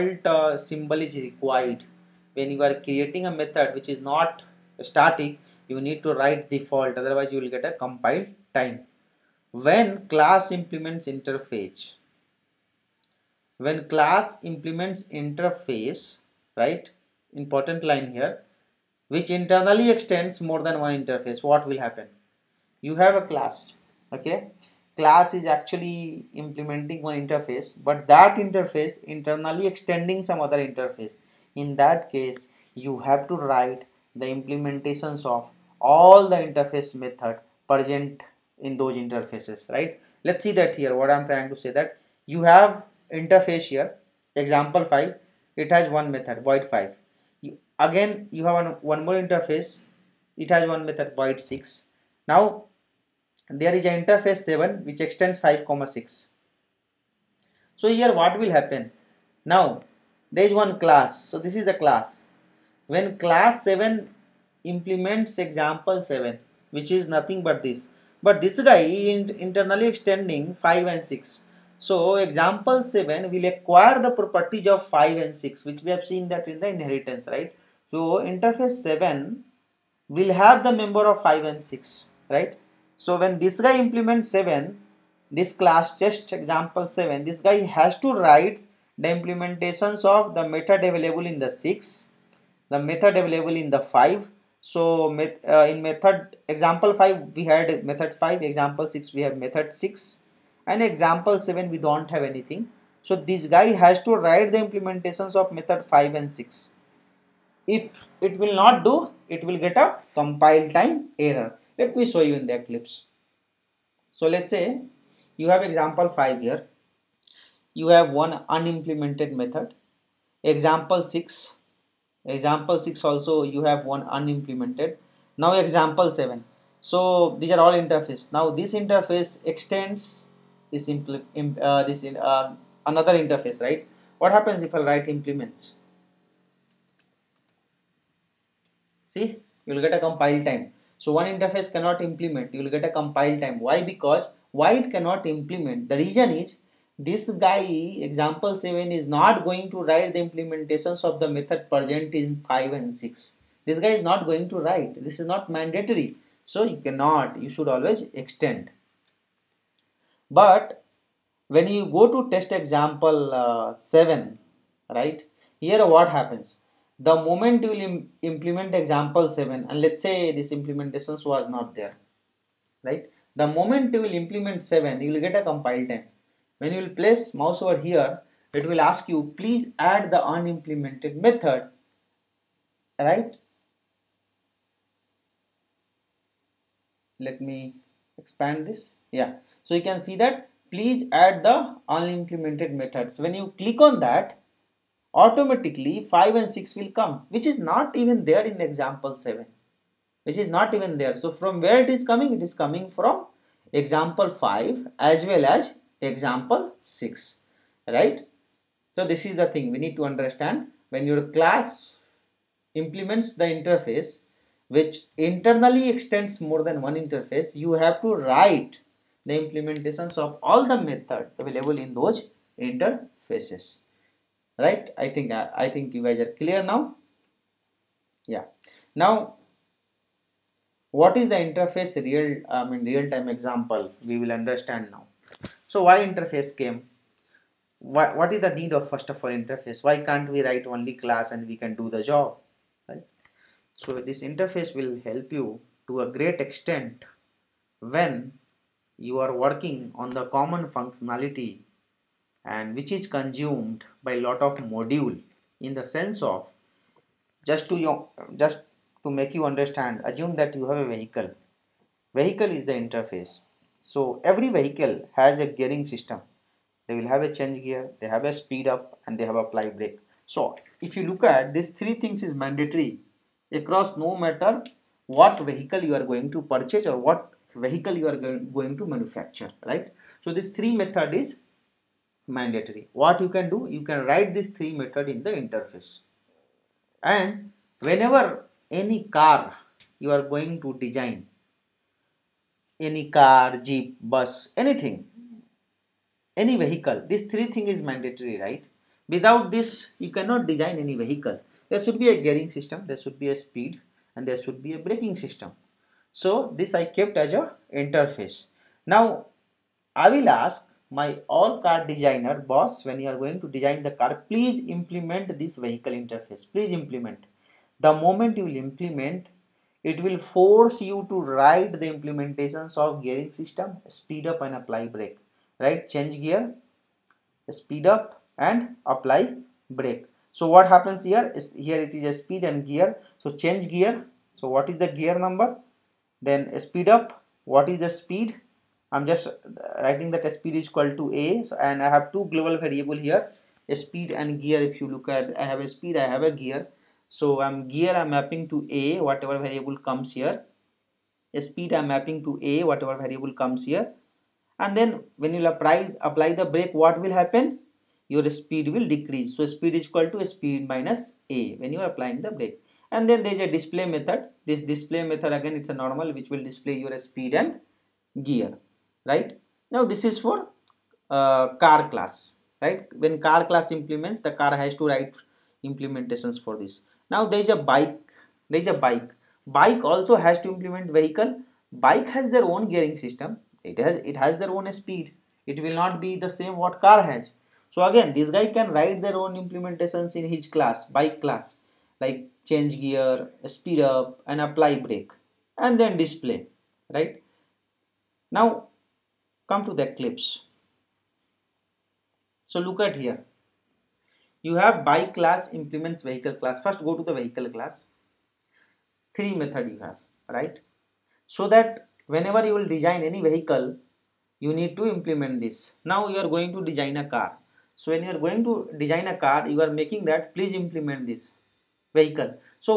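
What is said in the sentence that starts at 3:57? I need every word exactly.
Why, what is the need of first of all interface?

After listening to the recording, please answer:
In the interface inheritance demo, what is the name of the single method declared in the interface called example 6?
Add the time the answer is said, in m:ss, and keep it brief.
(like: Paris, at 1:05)
void 6, at 0:51.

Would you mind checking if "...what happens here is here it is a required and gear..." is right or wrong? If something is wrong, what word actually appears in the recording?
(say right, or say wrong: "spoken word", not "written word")
wrong: "speed", not "required".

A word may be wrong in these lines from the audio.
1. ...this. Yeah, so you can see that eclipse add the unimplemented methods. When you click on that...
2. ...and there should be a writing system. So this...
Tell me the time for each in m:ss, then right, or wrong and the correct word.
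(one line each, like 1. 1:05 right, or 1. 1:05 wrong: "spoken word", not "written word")
1. 3:08 wrong: "please", not "eclipse"
2. 5:04 wrong: "braking", not "writing".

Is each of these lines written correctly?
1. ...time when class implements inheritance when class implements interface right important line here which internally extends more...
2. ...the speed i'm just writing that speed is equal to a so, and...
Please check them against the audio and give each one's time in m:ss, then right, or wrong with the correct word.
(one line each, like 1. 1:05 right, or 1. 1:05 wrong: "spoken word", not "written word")
1. 0:08 wrong: "interface", not "inheritance"
2. 5:37 right.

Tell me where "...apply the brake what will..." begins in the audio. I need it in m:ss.
5:56.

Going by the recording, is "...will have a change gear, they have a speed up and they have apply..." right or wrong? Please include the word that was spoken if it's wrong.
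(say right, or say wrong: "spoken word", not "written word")
right.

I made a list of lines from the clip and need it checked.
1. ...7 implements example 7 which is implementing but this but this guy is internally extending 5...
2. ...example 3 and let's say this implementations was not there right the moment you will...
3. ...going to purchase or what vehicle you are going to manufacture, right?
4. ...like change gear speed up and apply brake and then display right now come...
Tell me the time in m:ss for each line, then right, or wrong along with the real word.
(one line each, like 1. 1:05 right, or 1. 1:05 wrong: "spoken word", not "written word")
1. 1:03 wrong: "nothing", not "implementing"
2. 2:48 wrong: "7", not "3"
3. 4:36 right
4. 6:32 right.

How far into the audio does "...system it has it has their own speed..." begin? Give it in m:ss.
6:23.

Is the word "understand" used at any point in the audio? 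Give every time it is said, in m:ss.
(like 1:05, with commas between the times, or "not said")
3:30, 3:54, 4:19.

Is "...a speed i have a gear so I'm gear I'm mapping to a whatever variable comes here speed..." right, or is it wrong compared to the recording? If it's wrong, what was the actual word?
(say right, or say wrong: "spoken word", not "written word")
right.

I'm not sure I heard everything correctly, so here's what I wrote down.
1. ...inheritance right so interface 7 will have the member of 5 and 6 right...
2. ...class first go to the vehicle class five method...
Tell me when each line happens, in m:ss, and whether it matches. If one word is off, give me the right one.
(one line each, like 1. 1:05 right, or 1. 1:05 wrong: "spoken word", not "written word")
1. 1:16 right
2. 6:46 wrong: "three", not "five".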